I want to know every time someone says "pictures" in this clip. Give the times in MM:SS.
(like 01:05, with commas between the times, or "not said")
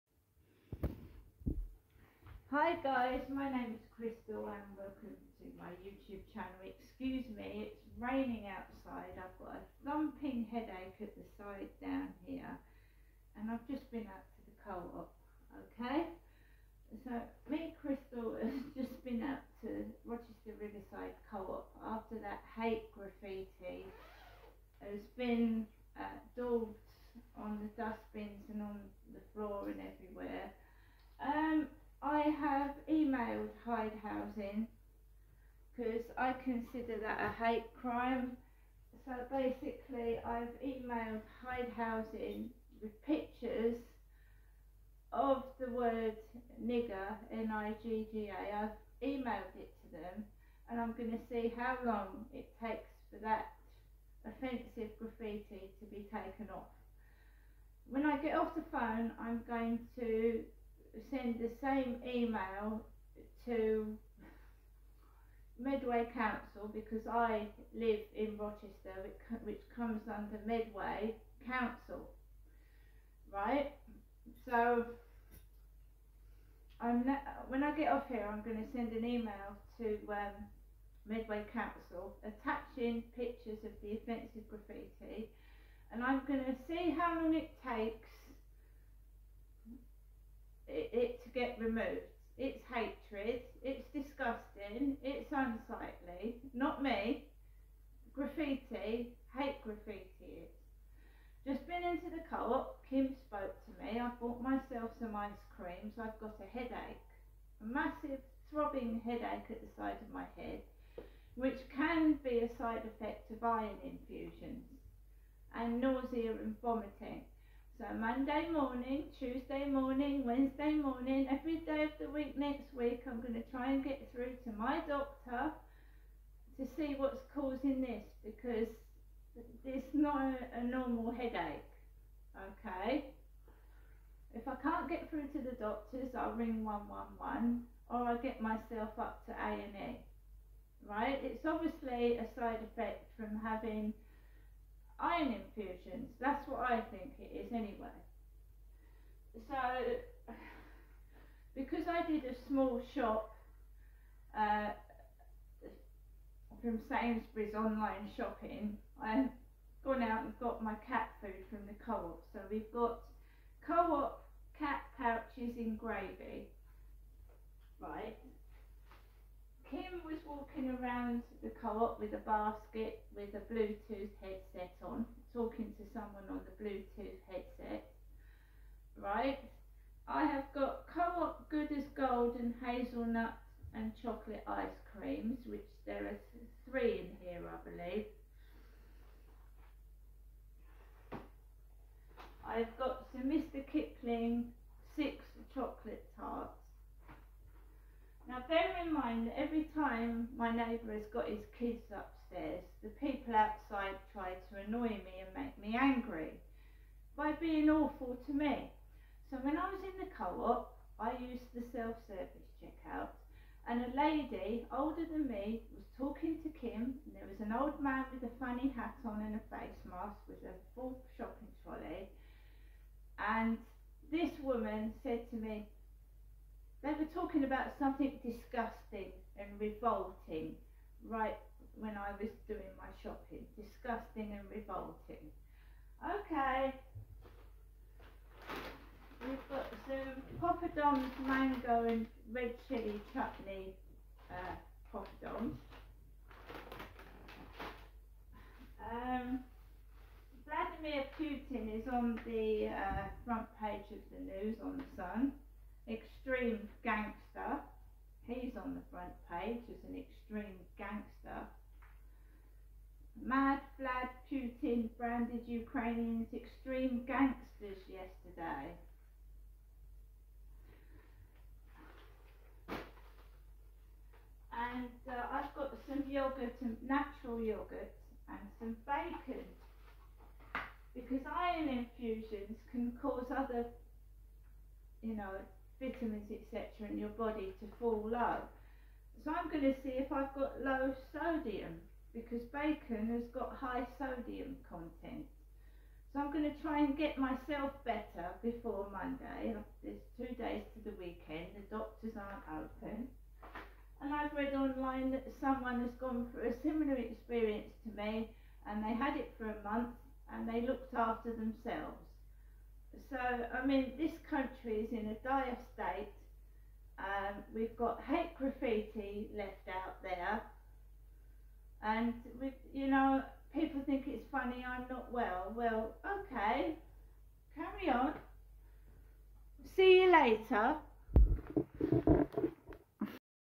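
00:43, 01:23.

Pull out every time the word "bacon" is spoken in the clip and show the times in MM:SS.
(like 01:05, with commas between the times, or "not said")
04:38, 04:52.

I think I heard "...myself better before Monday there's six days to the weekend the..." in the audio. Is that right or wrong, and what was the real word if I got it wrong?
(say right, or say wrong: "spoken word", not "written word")
wrong: "two", not "six".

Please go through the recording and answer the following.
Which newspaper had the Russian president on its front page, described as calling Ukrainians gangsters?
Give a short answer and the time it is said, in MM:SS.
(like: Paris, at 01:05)
The Sun, at 04:14.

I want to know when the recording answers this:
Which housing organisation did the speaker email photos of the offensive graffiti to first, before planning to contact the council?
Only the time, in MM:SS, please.
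00:41.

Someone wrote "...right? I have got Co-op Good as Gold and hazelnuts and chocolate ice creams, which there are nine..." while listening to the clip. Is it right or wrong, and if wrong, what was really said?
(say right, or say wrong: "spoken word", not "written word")
wrong: "three", not "nine".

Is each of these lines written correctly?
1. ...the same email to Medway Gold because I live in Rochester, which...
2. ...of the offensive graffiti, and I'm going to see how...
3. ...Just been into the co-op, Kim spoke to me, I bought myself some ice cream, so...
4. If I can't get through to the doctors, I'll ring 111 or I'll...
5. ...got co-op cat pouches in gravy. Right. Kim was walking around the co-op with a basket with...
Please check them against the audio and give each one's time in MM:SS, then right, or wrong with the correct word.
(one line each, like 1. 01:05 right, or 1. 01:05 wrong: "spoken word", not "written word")
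1. 01:01 wrong: "Council", not "Gold"
2. 01:23 right
3. 01:41 right
4. 02:14 right
5. 02:42 right.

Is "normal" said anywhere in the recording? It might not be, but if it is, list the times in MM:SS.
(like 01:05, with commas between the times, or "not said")
02:10.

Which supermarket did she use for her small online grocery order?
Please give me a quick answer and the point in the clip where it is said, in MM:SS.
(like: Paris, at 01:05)
Sainsbury's, at 02:36.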